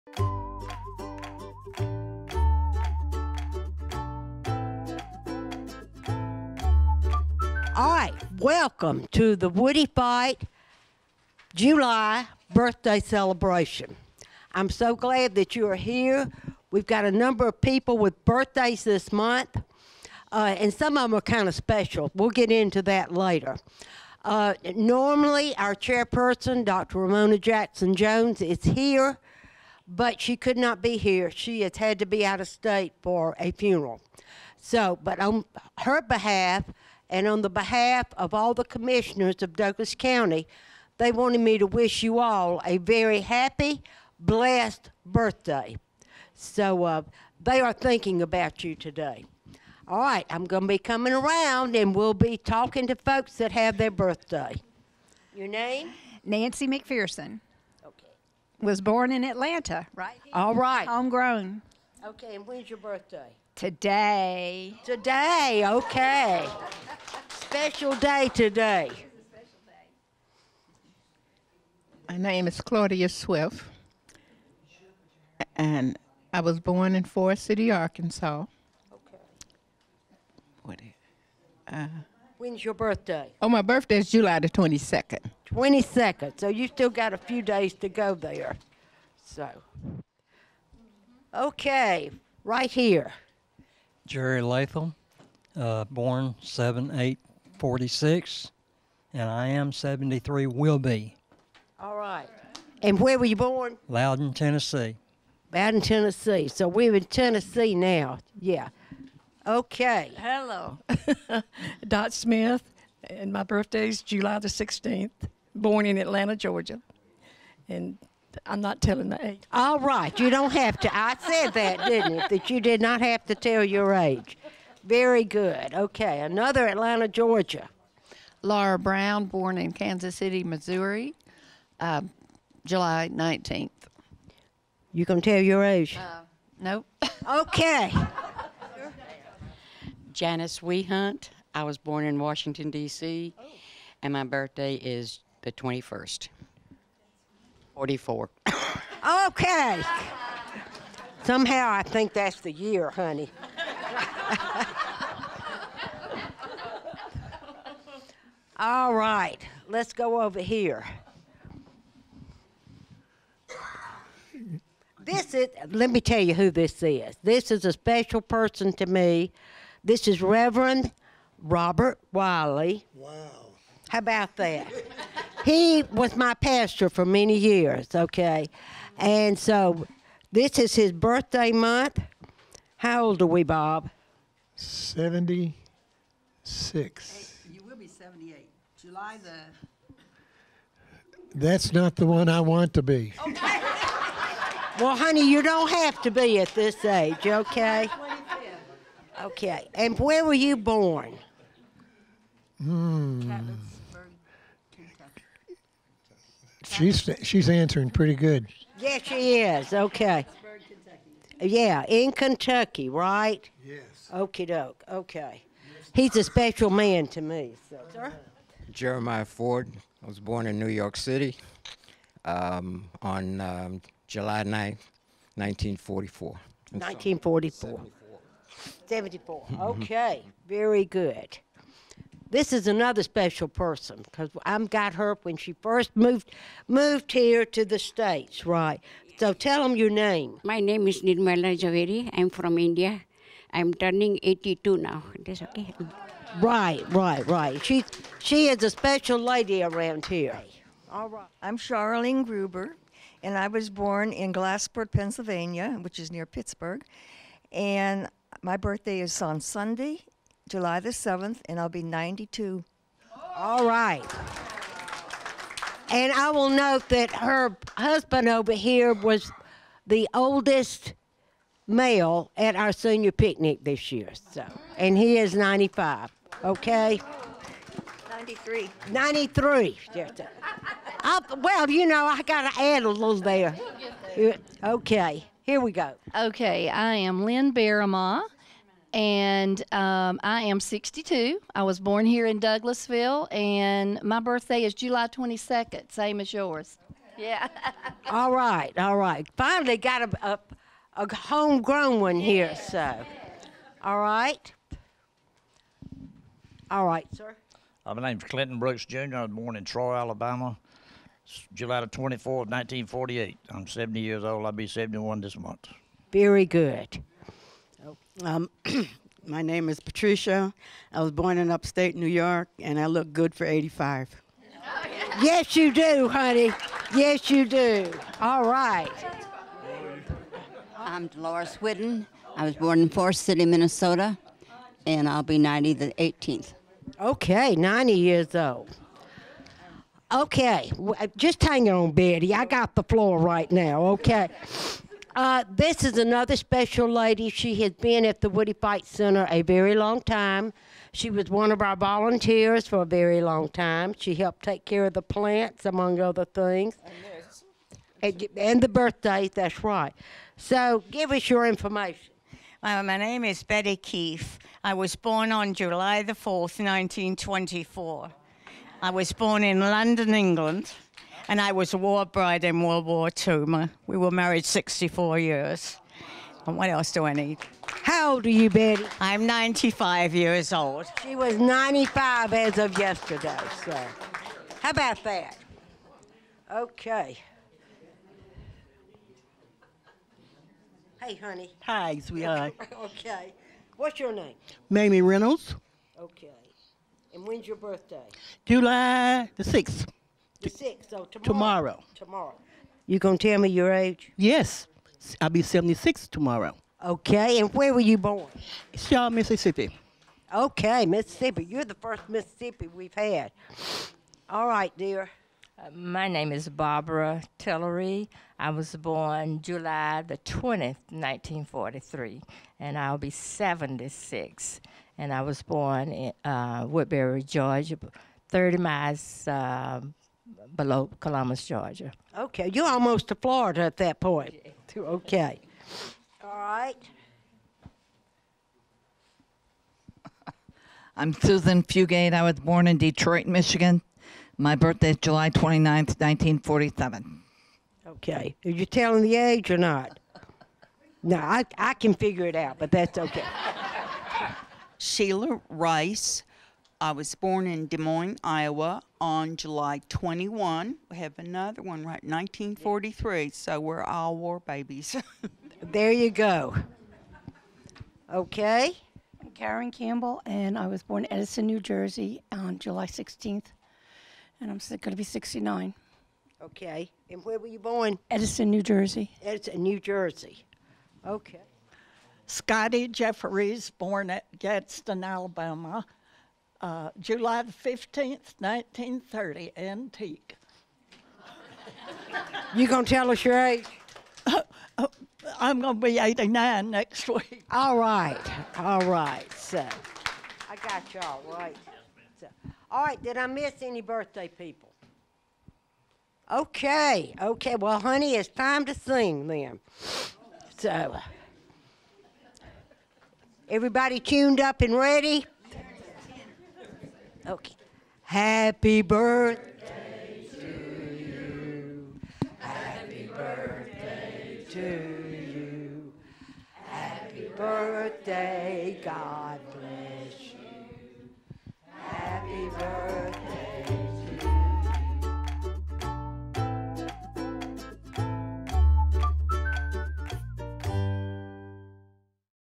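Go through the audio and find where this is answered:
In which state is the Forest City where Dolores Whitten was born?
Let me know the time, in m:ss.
5:33.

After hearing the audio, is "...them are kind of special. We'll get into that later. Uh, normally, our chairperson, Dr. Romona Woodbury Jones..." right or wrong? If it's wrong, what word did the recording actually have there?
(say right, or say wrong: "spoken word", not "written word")
wrong: "Jackson", not "Woodbury".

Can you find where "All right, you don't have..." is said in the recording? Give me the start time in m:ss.
1:59.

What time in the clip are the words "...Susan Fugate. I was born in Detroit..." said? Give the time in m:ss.
7:21.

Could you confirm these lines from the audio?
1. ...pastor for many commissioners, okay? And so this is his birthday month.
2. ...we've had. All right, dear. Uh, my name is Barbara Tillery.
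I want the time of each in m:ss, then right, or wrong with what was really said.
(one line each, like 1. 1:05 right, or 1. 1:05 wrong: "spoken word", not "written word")
1. 2:56 wrong: "years", not "commissioners"
2. 6:52 right.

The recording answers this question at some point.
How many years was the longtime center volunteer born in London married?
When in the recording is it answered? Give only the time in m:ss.
6:14.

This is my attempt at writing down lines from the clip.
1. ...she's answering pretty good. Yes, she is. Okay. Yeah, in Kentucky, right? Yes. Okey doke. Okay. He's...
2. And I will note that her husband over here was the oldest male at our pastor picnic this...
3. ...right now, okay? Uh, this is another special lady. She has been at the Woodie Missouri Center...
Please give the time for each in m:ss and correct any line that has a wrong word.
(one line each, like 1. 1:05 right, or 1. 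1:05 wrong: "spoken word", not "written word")
1. 3:27 right
2. 4:25 wrong: "senior", not "pastor"
3. 5:43 wrong: "Fite", not "Missouri".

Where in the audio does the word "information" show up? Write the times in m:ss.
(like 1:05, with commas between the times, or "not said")
6:01.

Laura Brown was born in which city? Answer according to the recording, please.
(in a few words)
Kansas City, Missouri.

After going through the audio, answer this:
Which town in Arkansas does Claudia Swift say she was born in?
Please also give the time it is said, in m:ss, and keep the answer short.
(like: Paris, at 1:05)
Forrest City, at 1:17.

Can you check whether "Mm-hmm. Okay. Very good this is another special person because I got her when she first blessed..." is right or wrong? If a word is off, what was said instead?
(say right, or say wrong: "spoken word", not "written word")
wrong: "moved", not "blessed".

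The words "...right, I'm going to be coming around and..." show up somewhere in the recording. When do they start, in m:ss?
0:49.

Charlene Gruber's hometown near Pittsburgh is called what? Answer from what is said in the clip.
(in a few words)
Glassport.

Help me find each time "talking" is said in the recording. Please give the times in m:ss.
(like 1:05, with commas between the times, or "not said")
0:52.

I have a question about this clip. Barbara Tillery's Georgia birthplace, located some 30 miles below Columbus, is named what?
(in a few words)
Woodbury.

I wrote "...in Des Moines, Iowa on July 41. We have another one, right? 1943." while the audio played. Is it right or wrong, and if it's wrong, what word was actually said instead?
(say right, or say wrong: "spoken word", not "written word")
wrong: "21", not "41".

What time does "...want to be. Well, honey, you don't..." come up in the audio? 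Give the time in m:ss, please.
3:12.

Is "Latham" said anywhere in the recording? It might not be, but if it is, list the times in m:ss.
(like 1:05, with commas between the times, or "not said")
1:34.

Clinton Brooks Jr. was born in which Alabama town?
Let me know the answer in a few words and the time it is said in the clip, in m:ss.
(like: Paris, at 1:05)
Troy, at 5:09.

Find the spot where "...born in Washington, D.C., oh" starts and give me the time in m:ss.
2:21.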